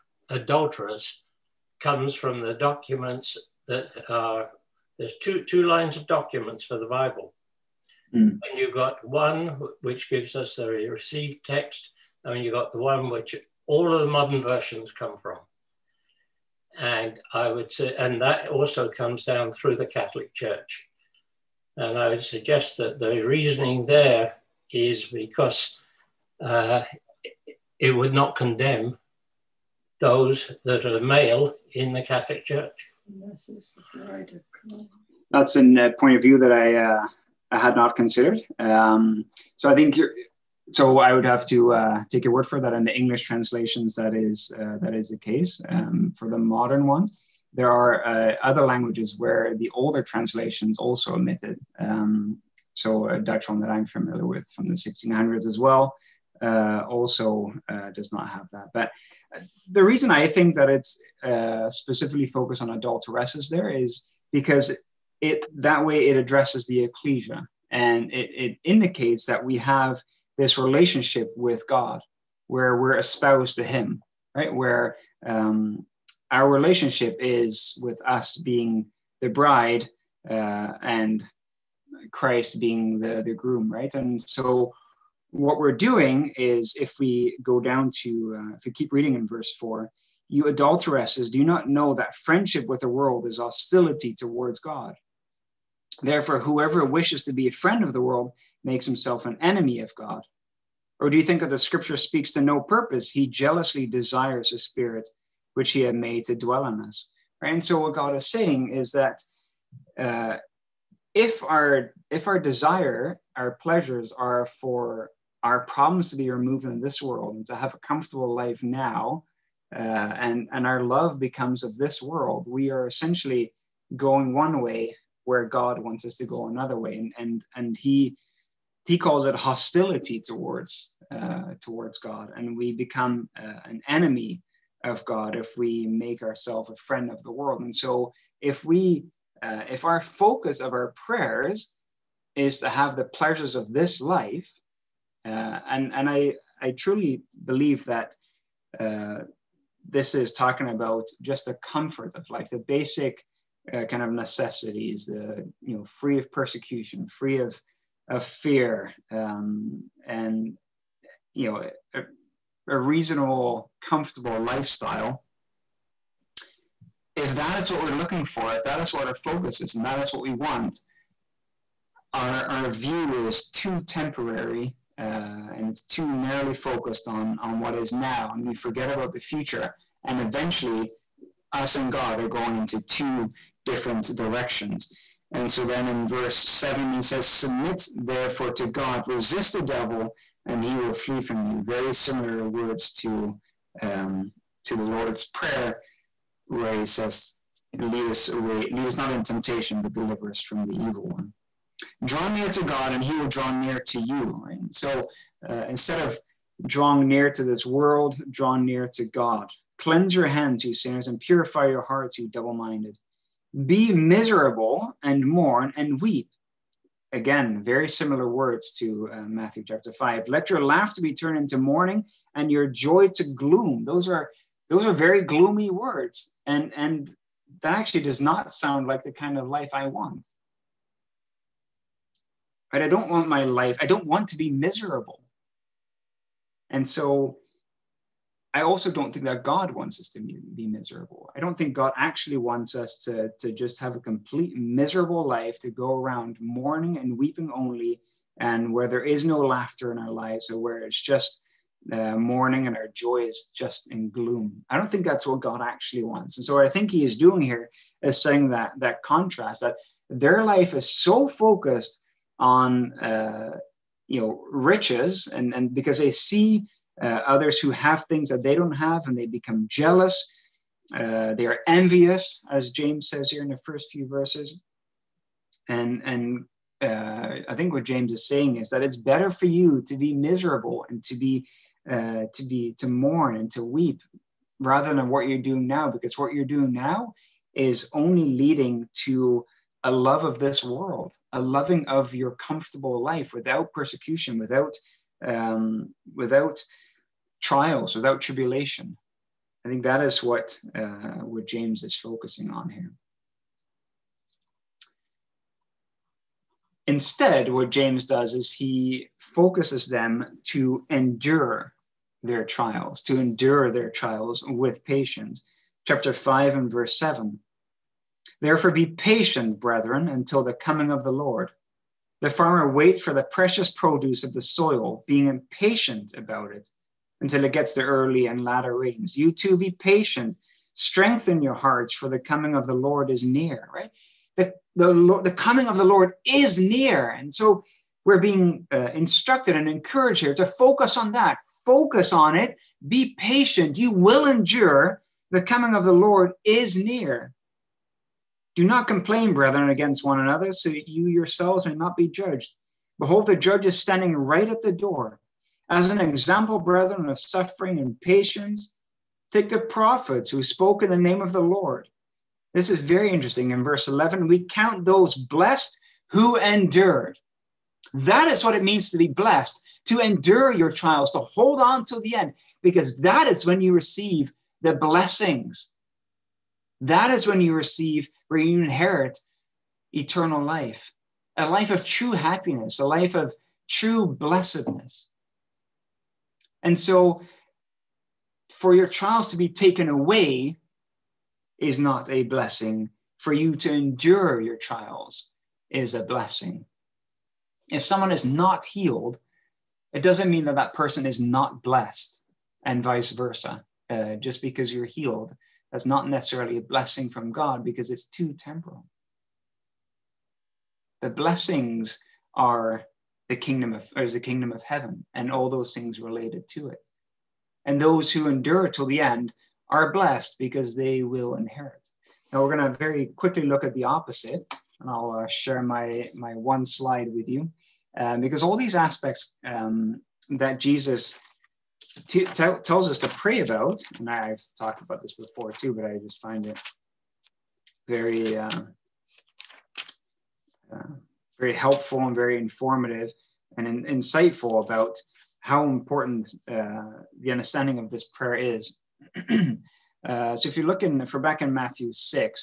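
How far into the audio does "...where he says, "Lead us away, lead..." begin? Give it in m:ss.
3:16.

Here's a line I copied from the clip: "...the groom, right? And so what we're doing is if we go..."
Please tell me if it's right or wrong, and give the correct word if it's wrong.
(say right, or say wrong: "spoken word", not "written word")
right.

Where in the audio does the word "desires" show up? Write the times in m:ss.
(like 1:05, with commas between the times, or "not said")
1:43, 1:52.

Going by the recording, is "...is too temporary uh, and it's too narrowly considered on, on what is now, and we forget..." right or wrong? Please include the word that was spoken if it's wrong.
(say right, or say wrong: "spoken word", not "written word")
wrong: "focused", not "considered".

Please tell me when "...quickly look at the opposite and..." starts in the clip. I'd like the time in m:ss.
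7:03.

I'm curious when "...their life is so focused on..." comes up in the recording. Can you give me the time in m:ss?
4:20.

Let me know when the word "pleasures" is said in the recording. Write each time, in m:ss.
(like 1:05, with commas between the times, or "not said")
1:53, 2:23.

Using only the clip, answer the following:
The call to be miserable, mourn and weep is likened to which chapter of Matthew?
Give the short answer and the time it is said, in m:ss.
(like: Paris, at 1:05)
Matthew chapter 5, at 3:39.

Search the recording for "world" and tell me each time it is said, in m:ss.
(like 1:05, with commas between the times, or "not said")
1:32, 1:38, 1:57, 2:02, 2:17, 3:27, 4:50.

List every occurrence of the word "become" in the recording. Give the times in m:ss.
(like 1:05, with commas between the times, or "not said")
2:01, 2:12, 4:29.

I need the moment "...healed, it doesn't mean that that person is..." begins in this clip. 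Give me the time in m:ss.
6:38.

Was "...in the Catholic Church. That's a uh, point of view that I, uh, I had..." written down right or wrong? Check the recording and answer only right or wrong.
right.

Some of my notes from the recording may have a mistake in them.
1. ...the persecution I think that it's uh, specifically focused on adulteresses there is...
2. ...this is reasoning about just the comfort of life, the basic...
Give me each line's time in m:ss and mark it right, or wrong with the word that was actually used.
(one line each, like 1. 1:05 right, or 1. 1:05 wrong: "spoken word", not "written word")
1. 0:59 wrong: "reason", not "persecution"
2. 2:29 wrong: "talking", not "reasoning".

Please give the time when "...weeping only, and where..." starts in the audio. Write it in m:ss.
4:07.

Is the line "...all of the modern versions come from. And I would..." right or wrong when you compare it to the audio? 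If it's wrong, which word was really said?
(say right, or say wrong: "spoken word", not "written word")
right.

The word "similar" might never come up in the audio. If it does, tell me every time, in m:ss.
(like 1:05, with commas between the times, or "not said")
3:11, 3:37.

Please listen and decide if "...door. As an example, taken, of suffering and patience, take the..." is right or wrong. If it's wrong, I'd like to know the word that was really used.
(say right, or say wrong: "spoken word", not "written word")
wrong: "brethren", not "taken".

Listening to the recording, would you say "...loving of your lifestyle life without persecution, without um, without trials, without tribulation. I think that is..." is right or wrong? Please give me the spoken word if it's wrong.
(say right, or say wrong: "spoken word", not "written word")
wrong: "comfortable", not "lifestyle".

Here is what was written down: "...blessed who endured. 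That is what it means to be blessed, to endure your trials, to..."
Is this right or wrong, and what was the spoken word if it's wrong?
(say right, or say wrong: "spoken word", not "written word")
right.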